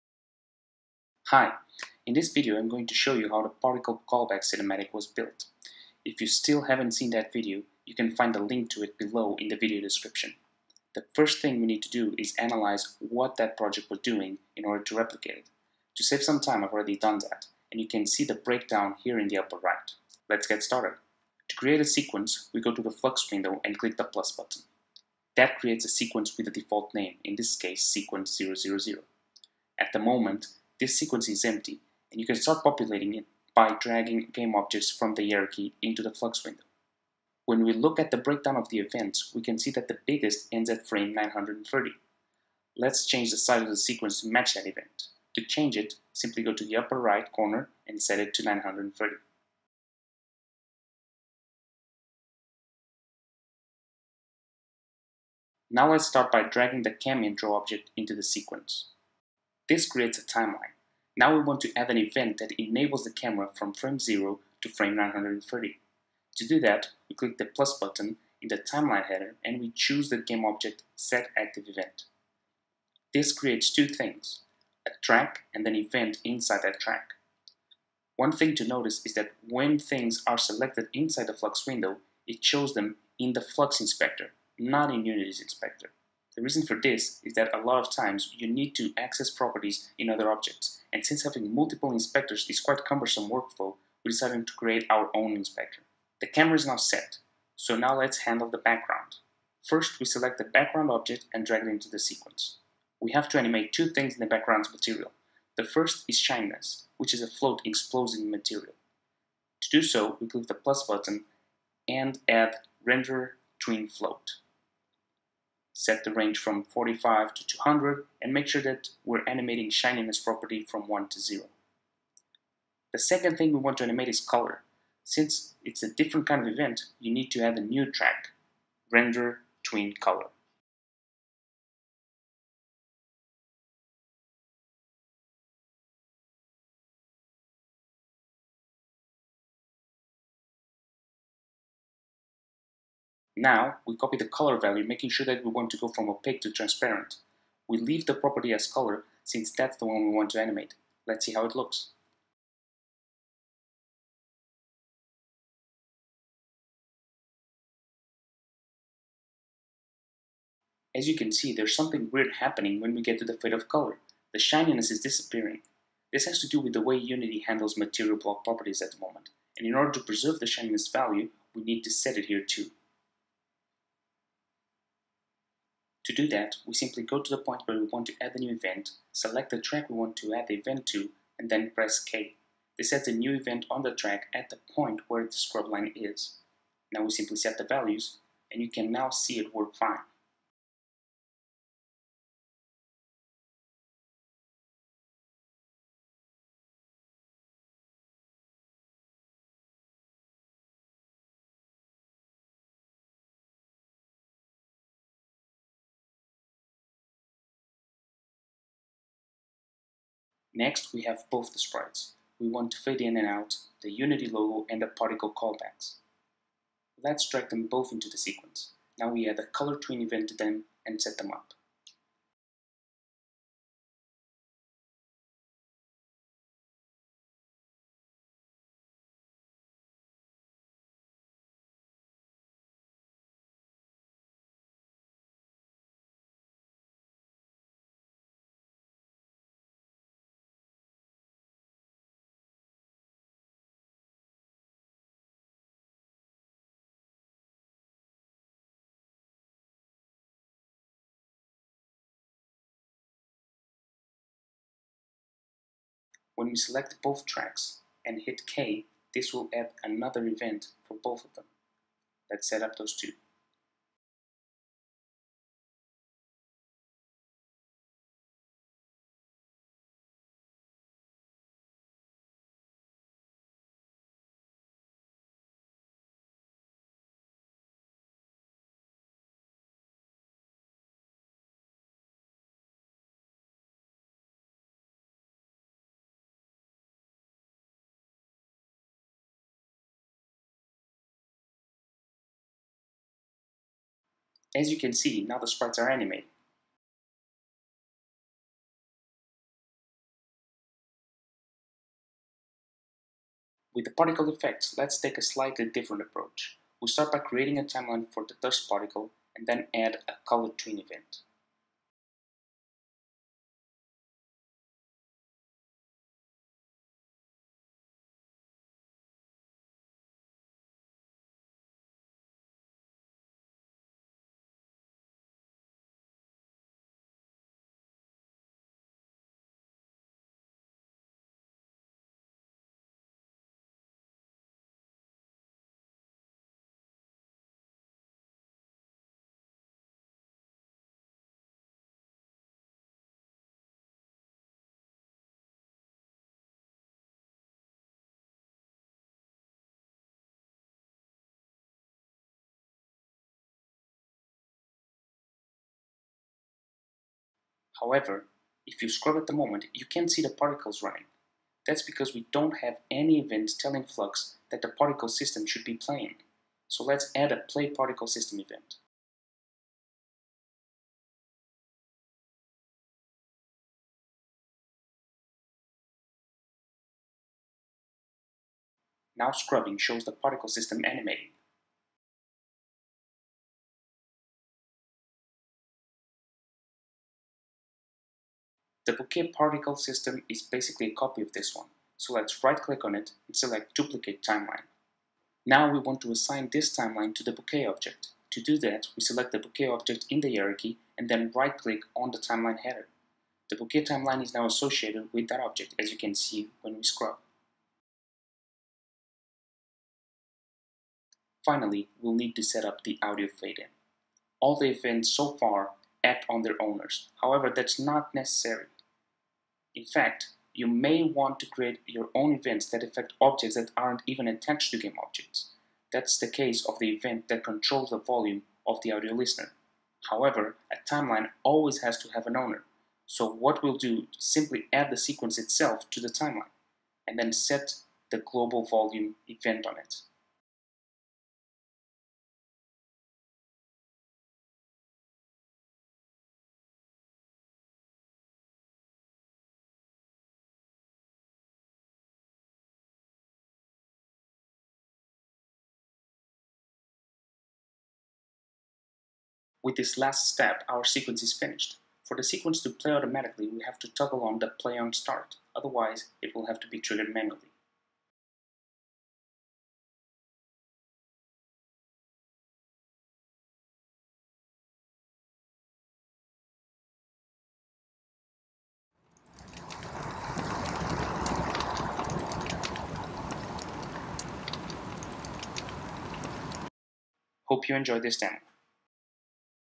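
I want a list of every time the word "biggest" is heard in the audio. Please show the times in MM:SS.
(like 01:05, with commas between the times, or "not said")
00:40.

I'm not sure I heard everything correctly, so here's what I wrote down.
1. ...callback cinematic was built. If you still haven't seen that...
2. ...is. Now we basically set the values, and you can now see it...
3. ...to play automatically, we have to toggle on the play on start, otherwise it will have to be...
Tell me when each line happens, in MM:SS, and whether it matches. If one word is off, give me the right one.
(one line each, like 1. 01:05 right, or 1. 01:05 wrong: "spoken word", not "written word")
1. 00:04 right
2. 03:05 wrong: "simply", not "basically"
3. 07:42 right.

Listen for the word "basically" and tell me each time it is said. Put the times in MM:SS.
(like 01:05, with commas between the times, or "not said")
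06:30.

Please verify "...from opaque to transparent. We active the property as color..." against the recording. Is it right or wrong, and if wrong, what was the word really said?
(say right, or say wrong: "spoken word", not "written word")
wrong: "leave", not "active".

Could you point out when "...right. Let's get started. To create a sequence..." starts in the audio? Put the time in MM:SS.
00:19.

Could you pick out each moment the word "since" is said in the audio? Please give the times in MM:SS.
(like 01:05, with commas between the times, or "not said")
01:31, 02:05, 02:29.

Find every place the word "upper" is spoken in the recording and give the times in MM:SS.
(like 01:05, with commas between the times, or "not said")
00:19, 00:46.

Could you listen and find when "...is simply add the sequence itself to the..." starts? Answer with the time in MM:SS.
07:14.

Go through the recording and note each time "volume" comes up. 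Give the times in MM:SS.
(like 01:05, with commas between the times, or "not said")
07:07, 07:18.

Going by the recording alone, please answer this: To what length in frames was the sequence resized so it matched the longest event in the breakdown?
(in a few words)
930.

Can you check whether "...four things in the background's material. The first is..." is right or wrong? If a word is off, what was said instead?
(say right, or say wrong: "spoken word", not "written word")
wrong: "two", not "four".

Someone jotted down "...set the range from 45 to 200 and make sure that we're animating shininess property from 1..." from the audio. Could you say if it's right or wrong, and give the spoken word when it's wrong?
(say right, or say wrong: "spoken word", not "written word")
right.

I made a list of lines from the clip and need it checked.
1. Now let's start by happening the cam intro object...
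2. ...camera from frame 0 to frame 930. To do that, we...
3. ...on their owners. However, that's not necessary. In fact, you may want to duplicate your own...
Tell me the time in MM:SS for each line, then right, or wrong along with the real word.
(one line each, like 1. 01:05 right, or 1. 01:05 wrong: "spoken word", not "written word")
1. 00:55 wrong: "dragging", not "happening"
2. 01:03 right
3. 06:56 wrong: "create", not "duplicate".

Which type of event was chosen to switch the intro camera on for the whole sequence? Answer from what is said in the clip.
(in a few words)
game object set active.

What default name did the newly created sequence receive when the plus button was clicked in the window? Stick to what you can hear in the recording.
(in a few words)
sequence 000.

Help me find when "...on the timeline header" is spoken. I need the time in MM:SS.
06:41.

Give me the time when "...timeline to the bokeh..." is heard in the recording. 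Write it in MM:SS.
06:36.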